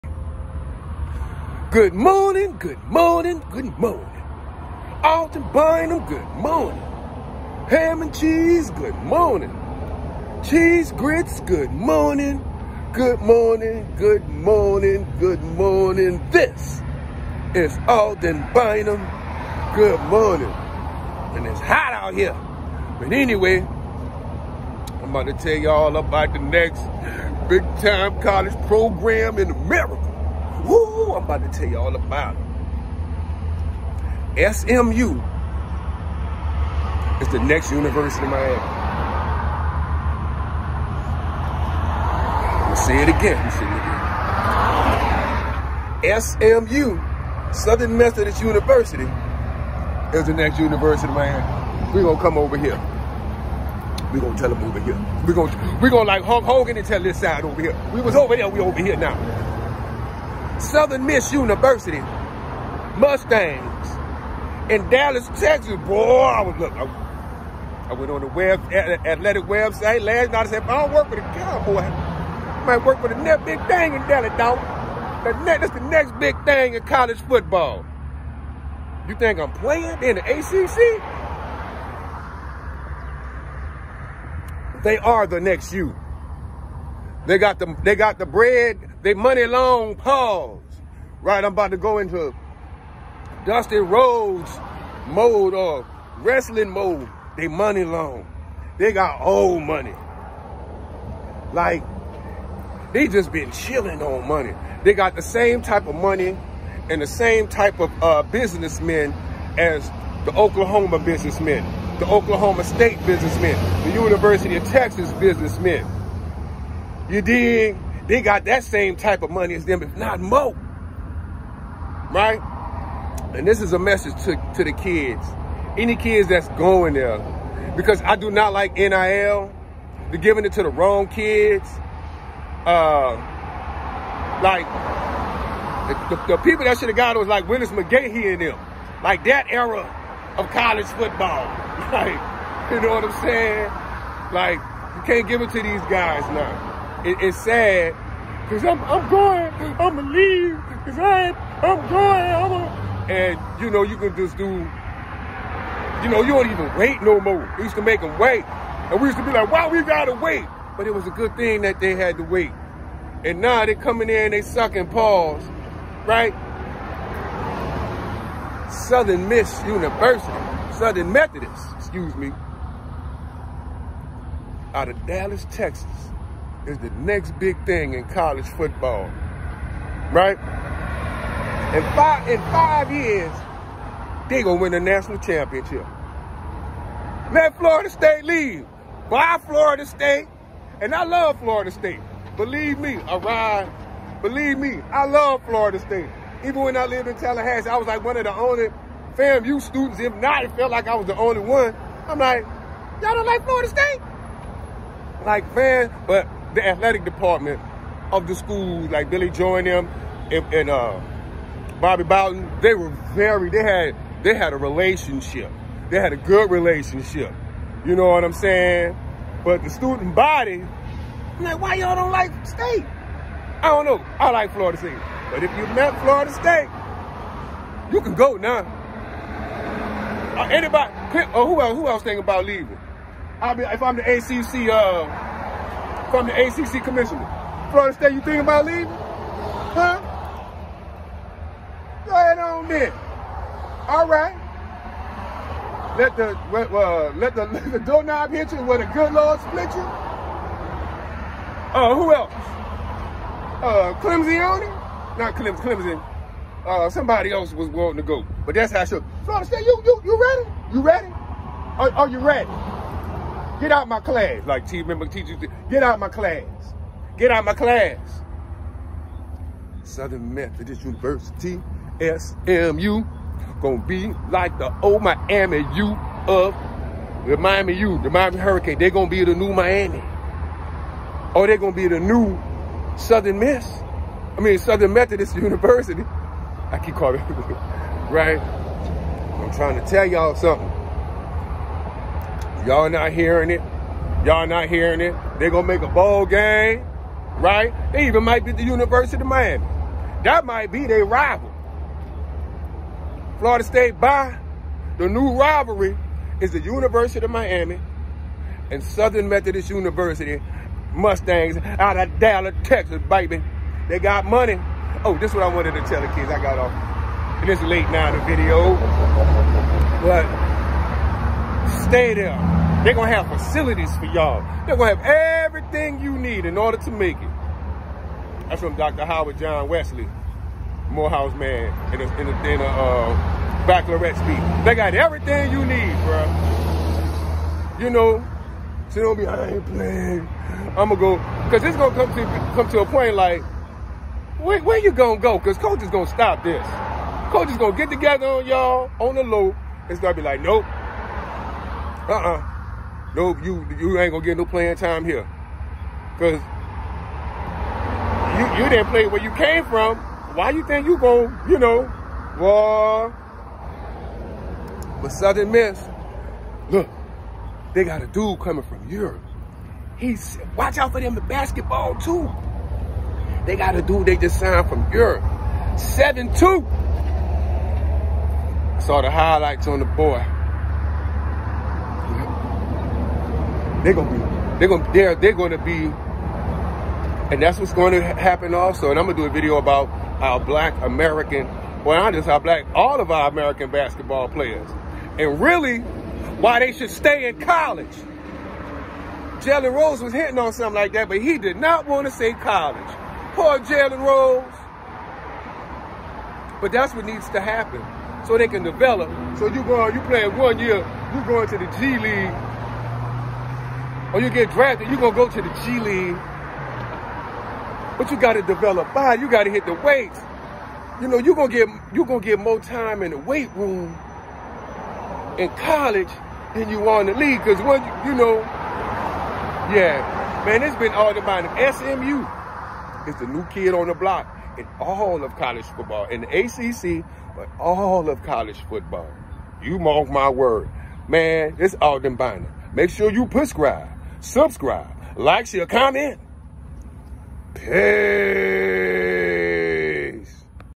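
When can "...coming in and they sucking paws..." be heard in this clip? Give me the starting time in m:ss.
2:43.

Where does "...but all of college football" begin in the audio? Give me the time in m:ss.
7:17.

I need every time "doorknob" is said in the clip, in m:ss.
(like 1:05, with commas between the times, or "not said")
4:07.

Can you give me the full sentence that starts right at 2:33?
And, you know, you can just do, you know, you don't even wait no more.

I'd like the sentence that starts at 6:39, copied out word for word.
Jalen Rose was hitting on something like that, but he did not want to say college.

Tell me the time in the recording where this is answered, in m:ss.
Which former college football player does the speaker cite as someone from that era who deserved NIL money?
2:17.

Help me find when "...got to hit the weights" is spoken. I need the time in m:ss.
6:59.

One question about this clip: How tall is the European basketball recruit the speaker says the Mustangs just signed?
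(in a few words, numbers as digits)
7-2.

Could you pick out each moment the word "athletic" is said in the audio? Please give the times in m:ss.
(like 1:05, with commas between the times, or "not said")
1:08, 3:26.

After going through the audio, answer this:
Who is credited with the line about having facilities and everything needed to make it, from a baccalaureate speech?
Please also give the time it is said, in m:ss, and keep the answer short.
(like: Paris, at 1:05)
Howard John Wesley, at 5:28.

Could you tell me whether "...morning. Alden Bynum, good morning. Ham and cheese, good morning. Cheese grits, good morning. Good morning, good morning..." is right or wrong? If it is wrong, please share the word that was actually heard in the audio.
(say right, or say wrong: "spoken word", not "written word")
right.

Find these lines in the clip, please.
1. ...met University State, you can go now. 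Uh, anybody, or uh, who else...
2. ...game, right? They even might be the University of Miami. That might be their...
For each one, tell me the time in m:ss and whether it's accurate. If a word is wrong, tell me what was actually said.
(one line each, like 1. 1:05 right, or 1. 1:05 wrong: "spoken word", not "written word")
1. 3:45 wrong: "Florida", not "University"
2. 4:56 right.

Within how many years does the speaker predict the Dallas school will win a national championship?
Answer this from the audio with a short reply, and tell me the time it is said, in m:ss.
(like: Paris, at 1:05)
5, at 3:01.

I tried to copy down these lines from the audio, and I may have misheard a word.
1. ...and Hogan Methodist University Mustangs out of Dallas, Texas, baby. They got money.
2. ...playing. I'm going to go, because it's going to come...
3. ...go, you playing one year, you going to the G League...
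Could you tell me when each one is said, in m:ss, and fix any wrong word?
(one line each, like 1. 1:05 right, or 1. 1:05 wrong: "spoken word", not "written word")
1. 5:08 wrong: "Southern", not "Hogan"
2. 5:39 right
3. 6:49 right.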